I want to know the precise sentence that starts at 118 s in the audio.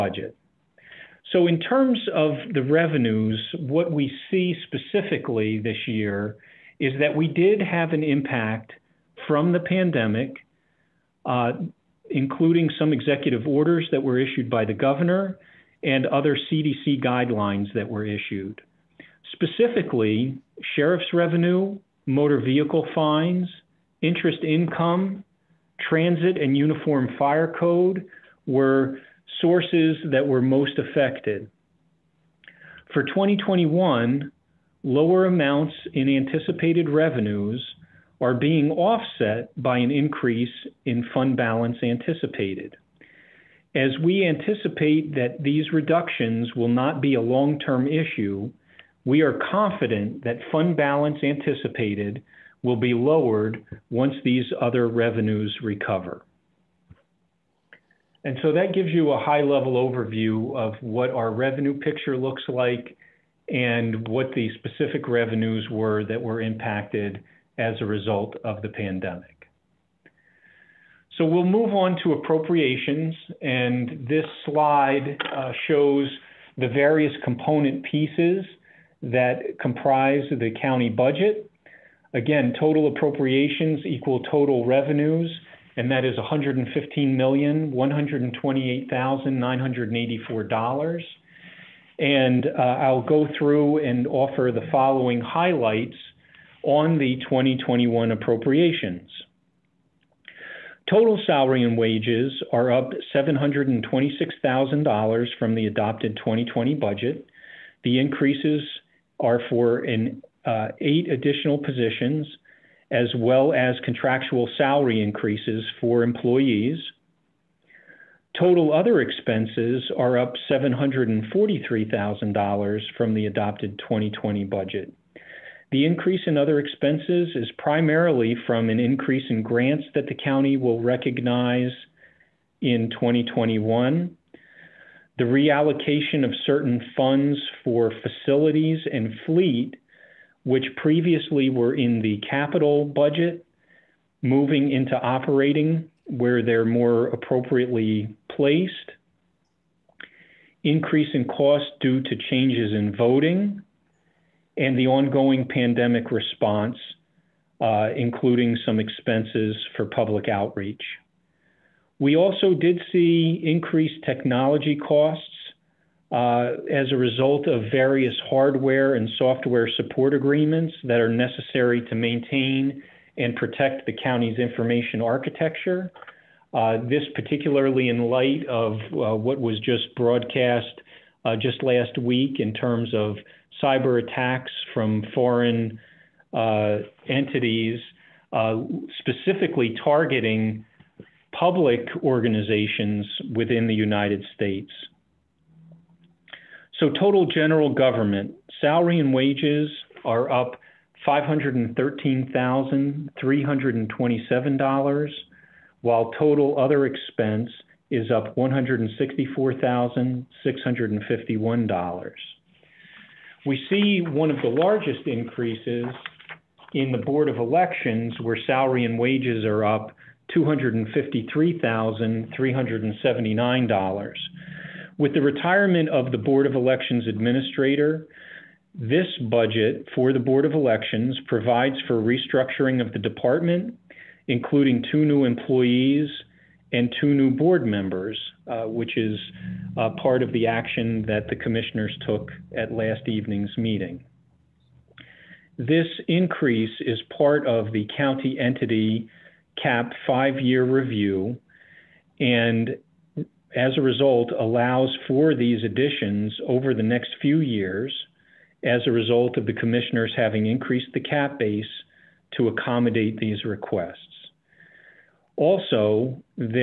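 Total other expenses are up $743,000 from the adopted 2020 budget.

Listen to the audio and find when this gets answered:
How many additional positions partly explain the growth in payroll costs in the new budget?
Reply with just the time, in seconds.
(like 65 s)
110 s.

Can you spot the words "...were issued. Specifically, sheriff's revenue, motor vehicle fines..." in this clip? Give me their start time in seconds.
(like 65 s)
17 s.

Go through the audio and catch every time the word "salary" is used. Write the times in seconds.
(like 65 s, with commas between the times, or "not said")
101 s, 114 s.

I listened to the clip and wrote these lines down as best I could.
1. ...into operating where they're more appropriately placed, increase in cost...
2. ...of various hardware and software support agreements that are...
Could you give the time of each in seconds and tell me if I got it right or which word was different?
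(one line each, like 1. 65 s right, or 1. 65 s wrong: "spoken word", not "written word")
1. 144 s right
2. 167 s right.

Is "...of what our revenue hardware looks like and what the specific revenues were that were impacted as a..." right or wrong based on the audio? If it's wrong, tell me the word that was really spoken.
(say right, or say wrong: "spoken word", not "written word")
wrong: "picture", not "hardware".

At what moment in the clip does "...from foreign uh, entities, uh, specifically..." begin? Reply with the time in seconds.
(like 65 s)
184 s.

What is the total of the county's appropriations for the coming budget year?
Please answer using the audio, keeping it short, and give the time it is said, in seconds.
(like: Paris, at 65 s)
$115,128,984, at 86 s.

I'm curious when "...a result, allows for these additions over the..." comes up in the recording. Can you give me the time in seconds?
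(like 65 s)
253 s.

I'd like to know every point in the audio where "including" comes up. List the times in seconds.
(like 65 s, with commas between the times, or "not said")
12 s, 157 s, 234 s.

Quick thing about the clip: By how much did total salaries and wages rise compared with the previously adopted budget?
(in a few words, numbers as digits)
$726,000.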